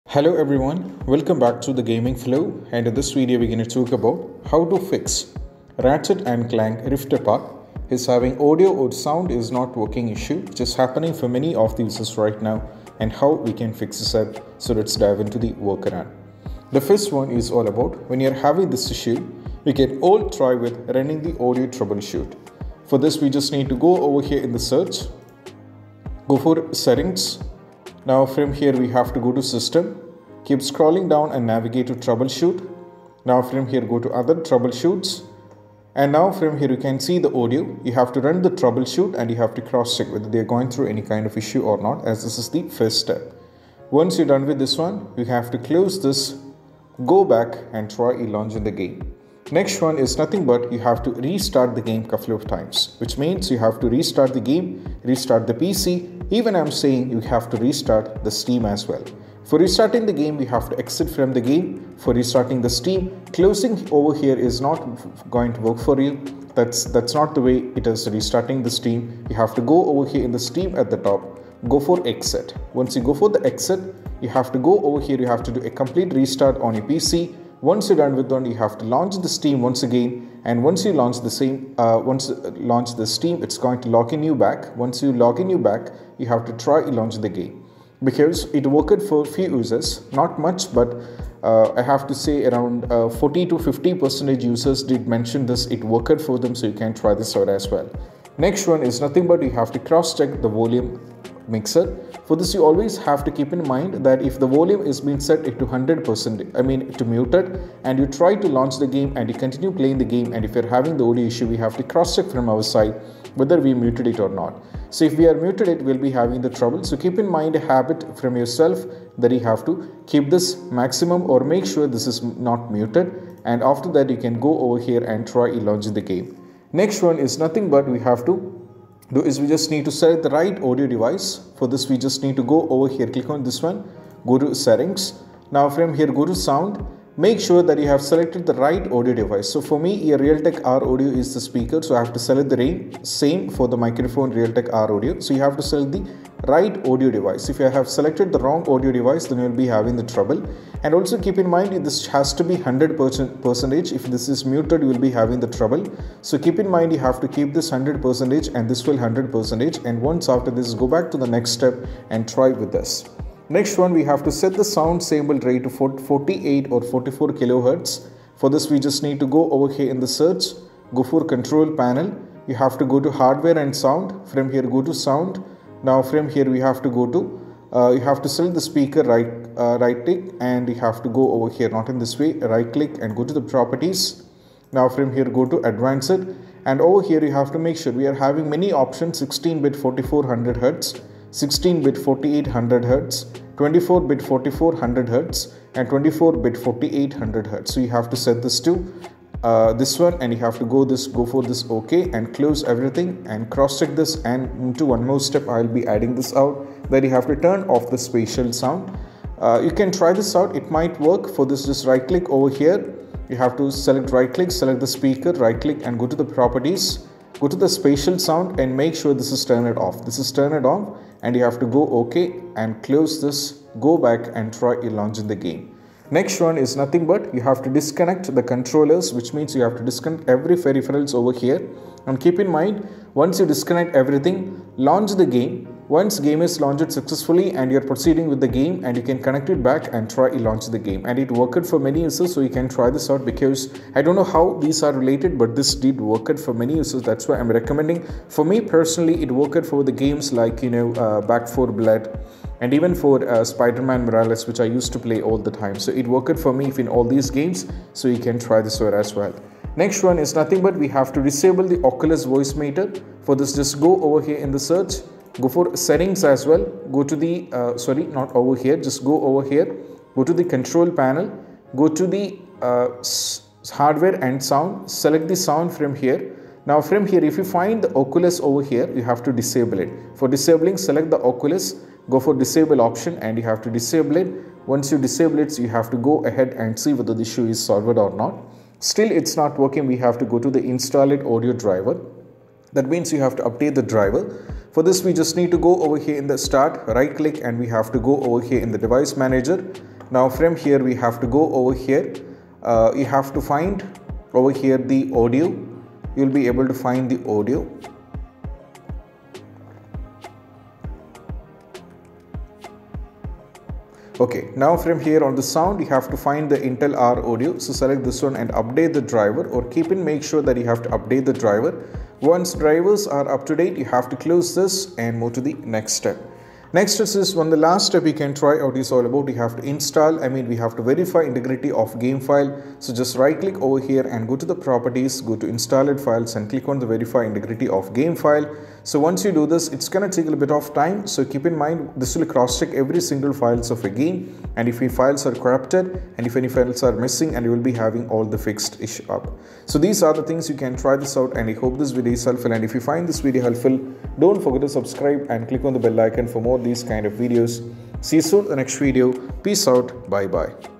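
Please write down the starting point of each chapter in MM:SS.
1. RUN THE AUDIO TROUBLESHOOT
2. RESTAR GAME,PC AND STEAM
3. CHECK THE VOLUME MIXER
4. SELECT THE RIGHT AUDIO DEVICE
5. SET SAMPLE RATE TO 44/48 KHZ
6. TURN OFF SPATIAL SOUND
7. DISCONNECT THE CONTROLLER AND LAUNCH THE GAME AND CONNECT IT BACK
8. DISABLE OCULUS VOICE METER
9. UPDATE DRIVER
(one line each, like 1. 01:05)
1. 00:32
2. 00:53
3. 01:42
4. 02:16
5. 02:53
6. 03:30
7. 03:50
8. 04:36
9. 05:03.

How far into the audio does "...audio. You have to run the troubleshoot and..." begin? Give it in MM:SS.
00:37.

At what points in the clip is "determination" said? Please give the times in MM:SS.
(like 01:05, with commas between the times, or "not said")
not said.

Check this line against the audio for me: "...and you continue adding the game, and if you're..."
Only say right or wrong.
wrong.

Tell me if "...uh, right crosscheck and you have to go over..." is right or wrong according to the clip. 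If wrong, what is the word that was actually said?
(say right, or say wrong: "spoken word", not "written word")
wrong: "click", not "crosscheck".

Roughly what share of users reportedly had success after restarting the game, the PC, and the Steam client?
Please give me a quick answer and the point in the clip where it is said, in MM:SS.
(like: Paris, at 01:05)
40 to 50 percent, at 01:33.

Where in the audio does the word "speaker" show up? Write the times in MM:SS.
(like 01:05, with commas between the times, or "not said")
02:21, 02:58, 03:34.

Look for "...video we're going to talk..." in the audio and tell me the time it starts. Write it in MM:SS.
00:03.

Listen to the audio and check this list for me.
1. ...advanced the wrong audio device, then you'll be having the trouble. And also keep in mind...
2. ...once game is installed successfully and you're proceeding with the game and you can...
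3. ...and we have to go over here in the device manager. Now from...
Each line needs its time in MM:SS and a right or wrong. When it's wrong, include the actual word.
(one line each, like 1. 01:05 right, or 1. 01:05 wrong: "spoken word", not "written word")
1. 02:27 wrong: "selected", not "advanced"
2. 03:55 wrong: "launched", not "installed"
3. 04:57 right.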